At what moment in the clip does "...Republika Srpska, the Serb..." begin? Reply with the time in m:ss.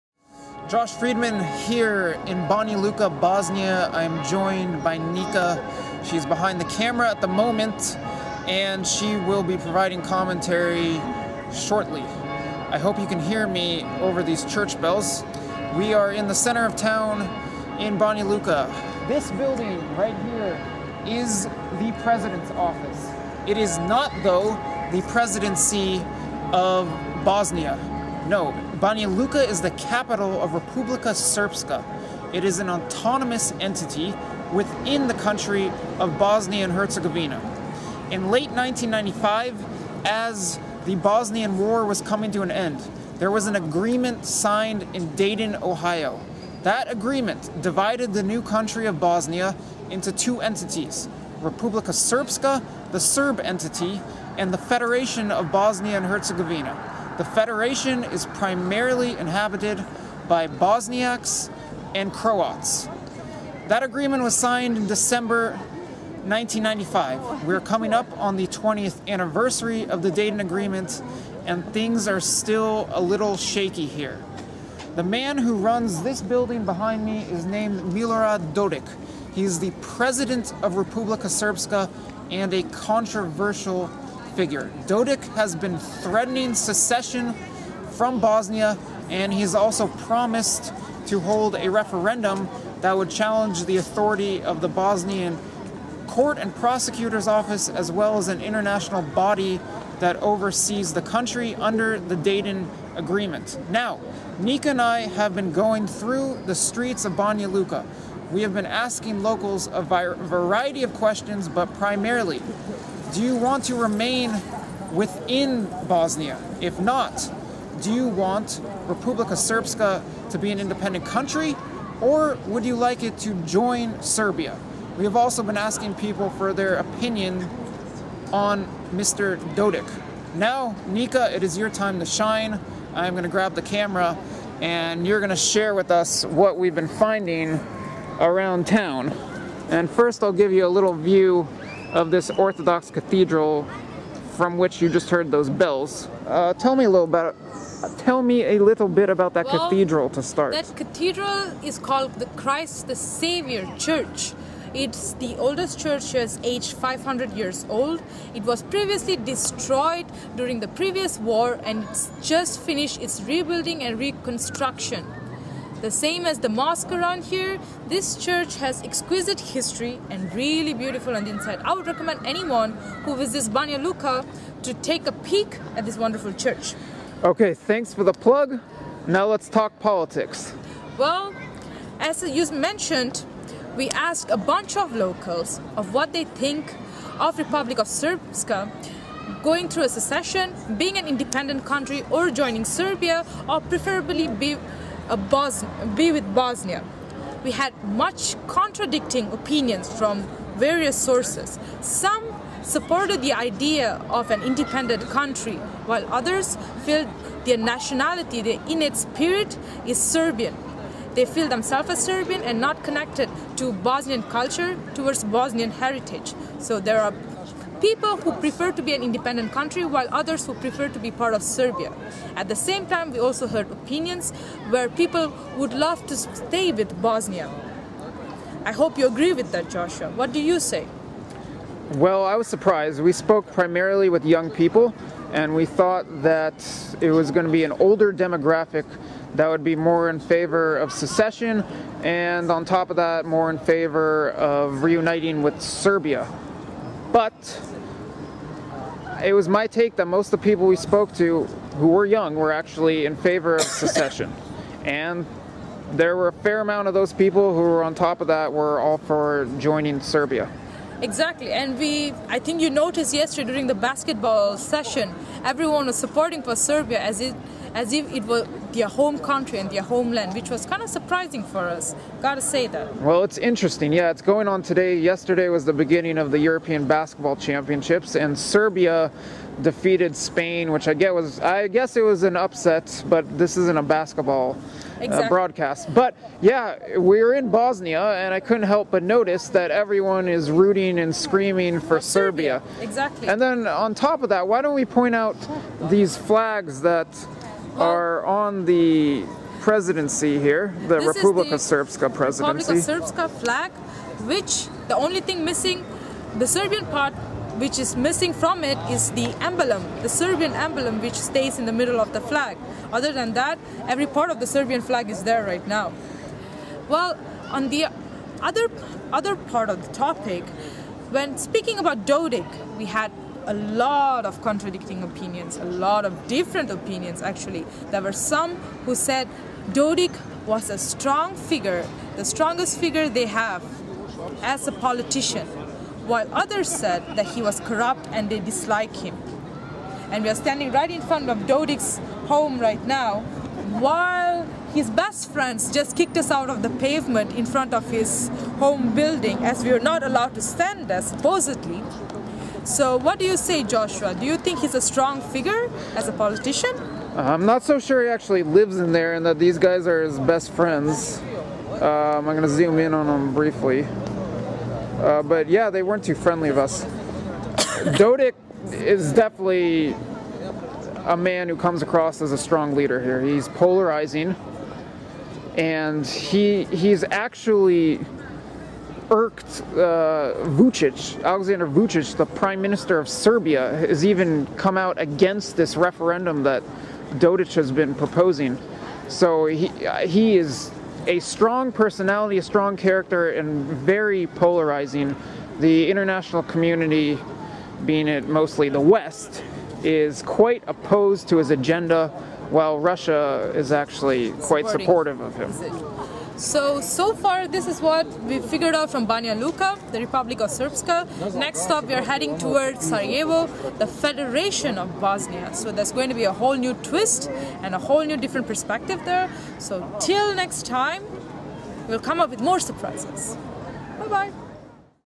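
0:51.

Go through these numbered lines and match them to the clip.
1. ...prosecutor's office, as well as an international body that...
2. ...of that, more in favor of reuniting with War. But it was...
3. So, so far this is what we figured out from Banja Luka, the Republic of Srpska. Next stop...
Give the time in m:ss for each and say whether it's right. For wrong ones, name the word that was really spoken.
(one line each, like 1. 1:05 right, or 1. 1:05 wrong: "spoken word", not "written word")
1. 1:36 right
2. 4:02 wrong: "Serbia", not "War"
3. 6:46 right.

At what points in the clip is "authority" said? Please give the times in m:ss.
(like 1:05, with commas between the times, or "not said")
1:33.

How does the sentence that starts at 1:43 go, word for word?
Now, Nika and I have been going through the streets of Banja Luka.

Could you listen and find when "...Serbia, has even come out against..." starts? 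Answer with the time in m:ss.
6:23.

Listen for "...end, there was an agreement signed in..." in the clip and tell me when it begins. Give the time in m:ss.
0:42.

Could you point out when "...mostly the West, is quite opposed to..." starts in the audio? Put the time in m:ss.
6:38.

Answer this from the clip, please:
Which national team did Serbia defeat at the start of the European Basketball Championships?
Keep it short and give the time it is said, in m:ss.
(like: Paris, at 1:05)
Spain, at 4:40.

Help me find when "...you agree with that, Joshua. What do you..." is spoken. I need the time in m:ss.
3:48.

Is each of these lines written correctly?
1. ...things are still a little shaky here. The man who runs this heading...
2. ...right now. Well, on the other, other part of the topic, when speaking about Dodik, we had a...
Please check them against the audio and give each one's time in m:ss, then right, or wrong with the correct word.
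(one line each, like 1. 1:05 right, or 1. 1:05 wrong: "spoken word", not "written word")
1. 1:11 wrong: "building", not "heading"
2. 5:15 right.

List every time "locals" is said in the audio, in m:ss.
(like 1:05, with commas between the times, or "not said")
1:49, 3:04.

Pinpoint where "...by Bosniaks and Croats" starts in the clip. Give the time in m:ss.
1:00.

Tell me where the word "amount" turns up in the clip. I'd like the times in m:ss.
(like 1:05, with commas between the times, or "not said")
4:16.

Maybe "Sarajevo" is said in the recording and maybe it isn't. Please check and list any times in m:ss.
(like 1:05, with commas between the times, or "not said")
6:52.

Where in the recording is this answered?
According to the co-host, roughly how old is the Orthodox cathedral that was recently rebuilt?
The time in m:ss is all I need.
2:36.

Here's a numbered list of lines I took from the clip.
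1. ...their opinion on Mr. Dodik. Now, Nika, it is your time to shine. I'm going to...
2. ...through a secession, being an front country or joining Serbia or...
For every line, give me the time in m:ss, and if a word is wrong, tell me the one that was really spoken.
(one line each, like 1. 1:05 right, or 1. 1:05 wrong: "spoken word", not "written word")
1. 2:06 right
2. 3:09 wrong: "independent", not "front".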